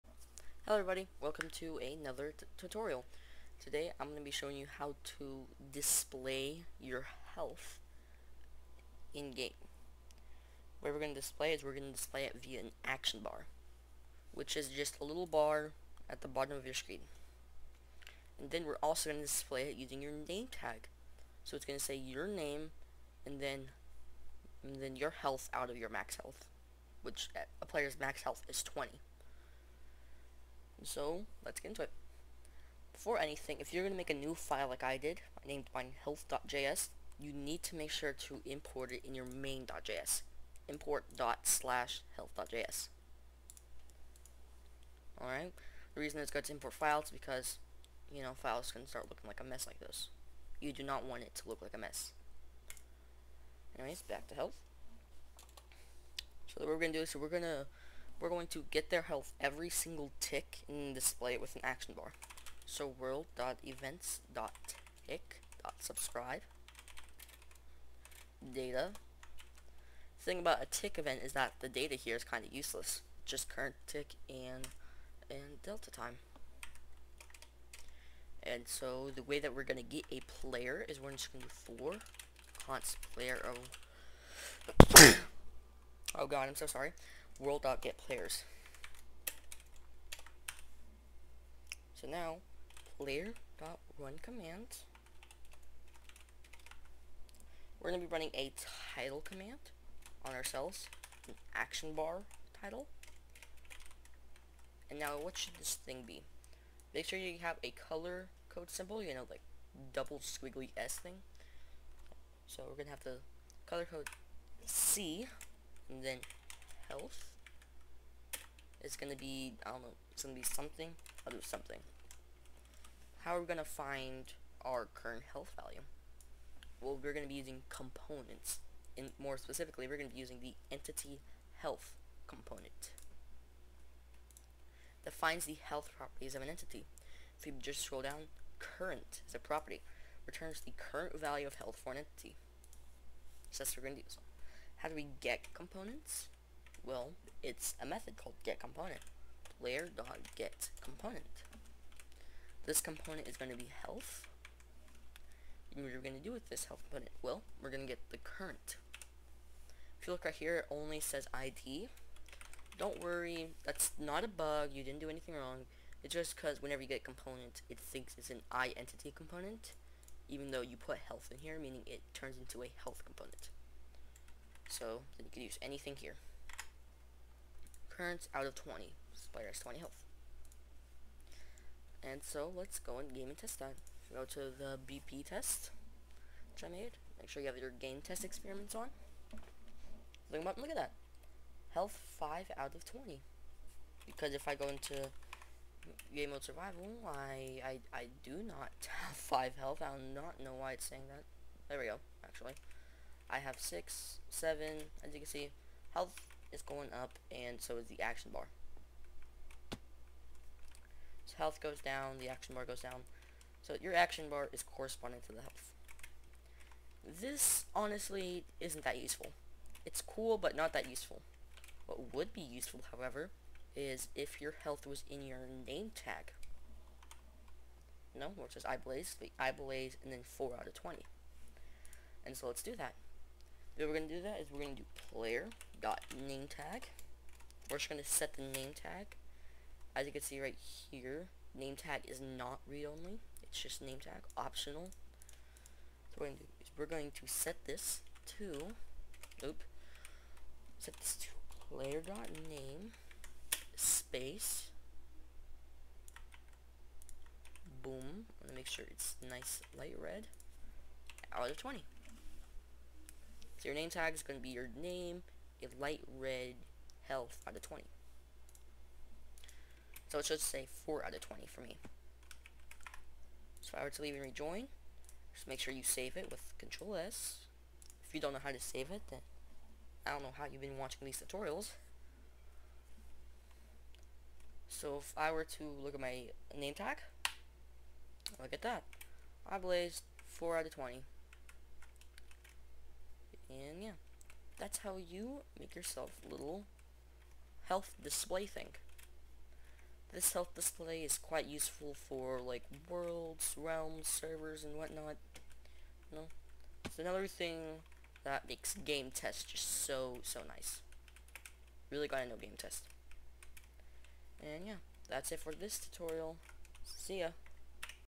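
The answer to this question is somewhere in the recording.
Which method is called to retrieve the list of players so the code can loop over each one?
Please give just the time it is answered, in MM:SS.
01:27.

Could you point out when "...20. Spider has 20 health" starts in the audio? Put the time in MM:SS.
02:58.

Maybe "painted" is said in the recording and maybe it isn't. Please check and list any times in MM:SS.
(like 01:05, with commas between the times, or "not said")
not said.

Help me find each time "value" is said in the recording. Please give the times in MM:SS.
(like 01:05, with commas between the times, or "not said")
02:05, 02:21.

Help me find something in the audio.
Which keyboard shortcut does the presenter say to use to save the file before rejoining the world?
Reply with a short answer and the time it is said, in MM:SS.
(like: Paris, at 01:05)
Control S, at 04:36.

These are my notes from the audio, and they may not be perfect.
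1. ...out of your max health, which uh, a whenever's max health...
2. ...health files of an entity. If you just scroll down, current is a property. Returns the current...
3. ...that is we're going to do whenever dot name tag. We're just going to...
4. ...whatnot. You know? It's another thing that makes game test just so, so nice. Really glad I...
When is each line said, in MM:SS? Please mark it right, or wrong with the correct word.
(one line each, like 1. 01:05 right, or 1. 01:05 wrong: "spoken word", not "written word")
1. 00:25 wrong: "player", not "whenever"
2. 02:15 wrong: "properties", not "files"
3. 03:54 wrong: "player", not "whenever"
4. 05:04 right.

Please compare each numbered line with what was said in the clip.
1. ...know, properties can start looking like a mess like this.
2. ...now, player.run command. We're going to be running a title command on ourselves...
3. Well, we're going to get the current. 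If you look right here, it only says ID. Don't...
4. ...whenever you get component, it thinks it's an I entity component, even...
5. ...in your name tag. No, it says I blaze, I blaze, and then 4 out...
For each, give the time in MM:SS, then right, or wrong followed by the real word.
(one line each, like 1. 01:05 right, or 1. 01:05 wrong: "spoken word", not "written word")
1. 00:48 wrong: "files", not "properties"
2. 01:32 right
3. 02:37 right
4. 02:46 right
5. 03:45 right.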